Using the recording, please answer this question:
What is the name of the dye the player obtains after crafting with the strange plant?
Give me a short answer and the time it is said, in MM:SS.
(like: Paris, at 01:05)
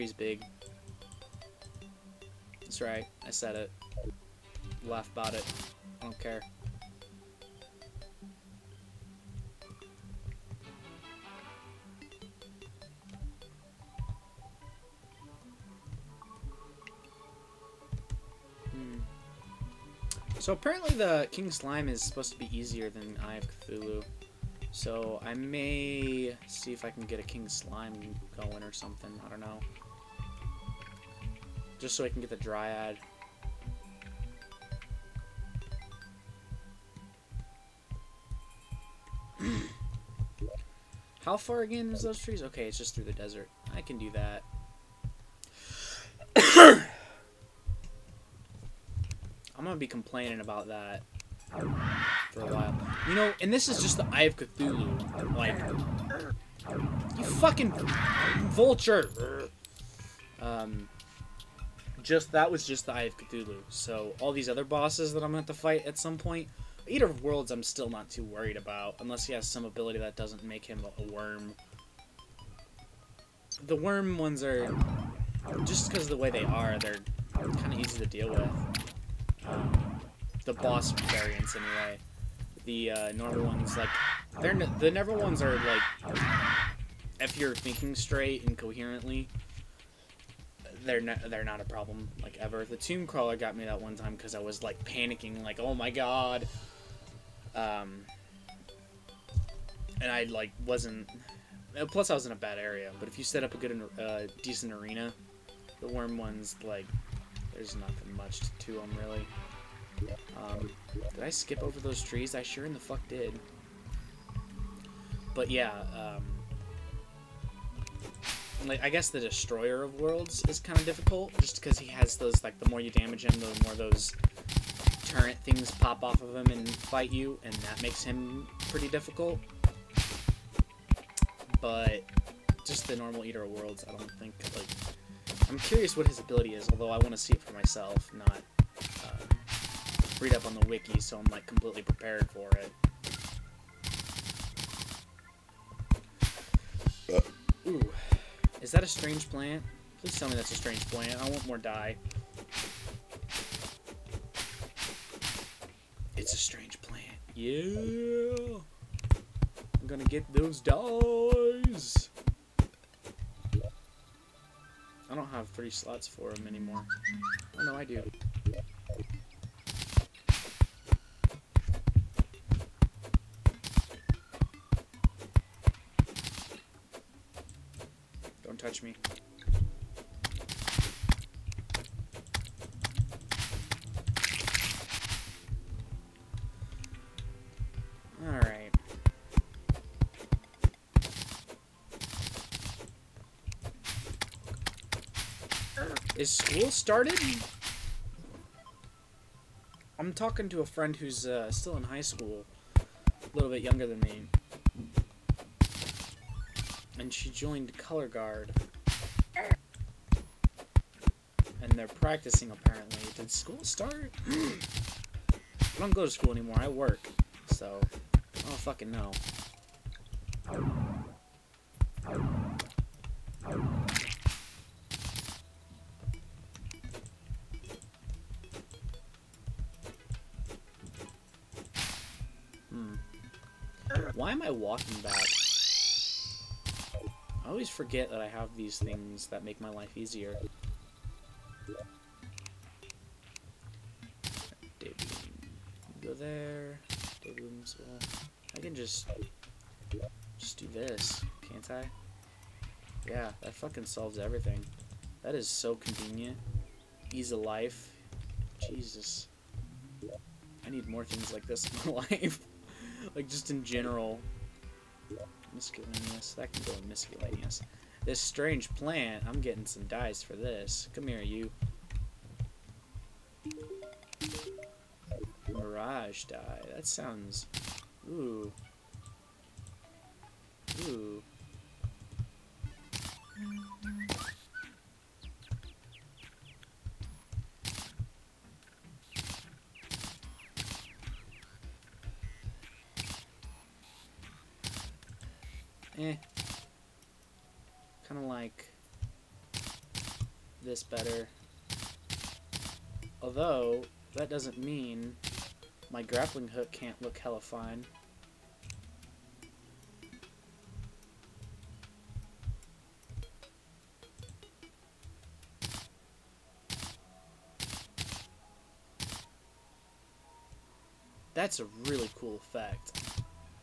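Mirage dye, at 04:35.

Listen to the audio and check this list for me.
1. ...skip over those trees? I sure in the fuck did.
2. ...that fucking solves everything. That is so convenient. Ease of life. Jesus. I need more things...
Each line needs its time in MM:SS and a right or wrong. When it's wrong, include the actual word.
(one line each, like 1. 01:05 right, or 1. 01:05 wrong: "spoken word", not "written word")
1. 01:51 right
2. 04:13 right.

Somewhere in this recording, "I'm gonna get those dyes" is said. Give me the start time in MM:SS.
02:39.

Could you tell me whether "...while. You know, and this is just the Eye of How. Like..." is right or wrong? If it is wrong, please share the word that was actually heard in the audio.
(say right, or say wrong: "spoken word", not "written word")
wrong: "Cthulhu", not "How".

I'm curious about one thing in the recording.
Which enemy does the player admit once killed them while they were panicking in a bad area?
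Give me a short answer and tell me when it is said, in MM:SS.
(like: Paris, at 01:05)
tomb crawler, at 01:32.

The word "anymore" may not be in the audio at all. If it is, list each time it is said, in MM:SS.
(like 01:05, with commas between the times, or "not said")
02:46, 03:36.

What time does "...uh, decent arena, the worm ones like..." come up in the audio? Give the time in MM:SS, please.
01:43.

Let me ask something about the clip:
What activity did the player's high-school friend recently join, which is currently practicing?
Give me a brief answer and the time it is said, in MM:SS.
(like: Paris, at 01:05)
Color Guard, at 03:27.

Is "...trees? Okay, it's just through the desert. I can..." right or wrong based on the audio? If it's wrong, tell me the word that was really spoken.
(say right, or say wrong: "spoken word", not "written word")
right.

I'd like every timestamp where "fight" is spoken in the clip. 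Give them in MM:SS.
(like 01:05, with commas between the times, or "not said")
01:05, 02:06.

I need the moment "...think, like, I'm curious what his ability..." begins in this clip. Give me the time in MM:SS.
02:14.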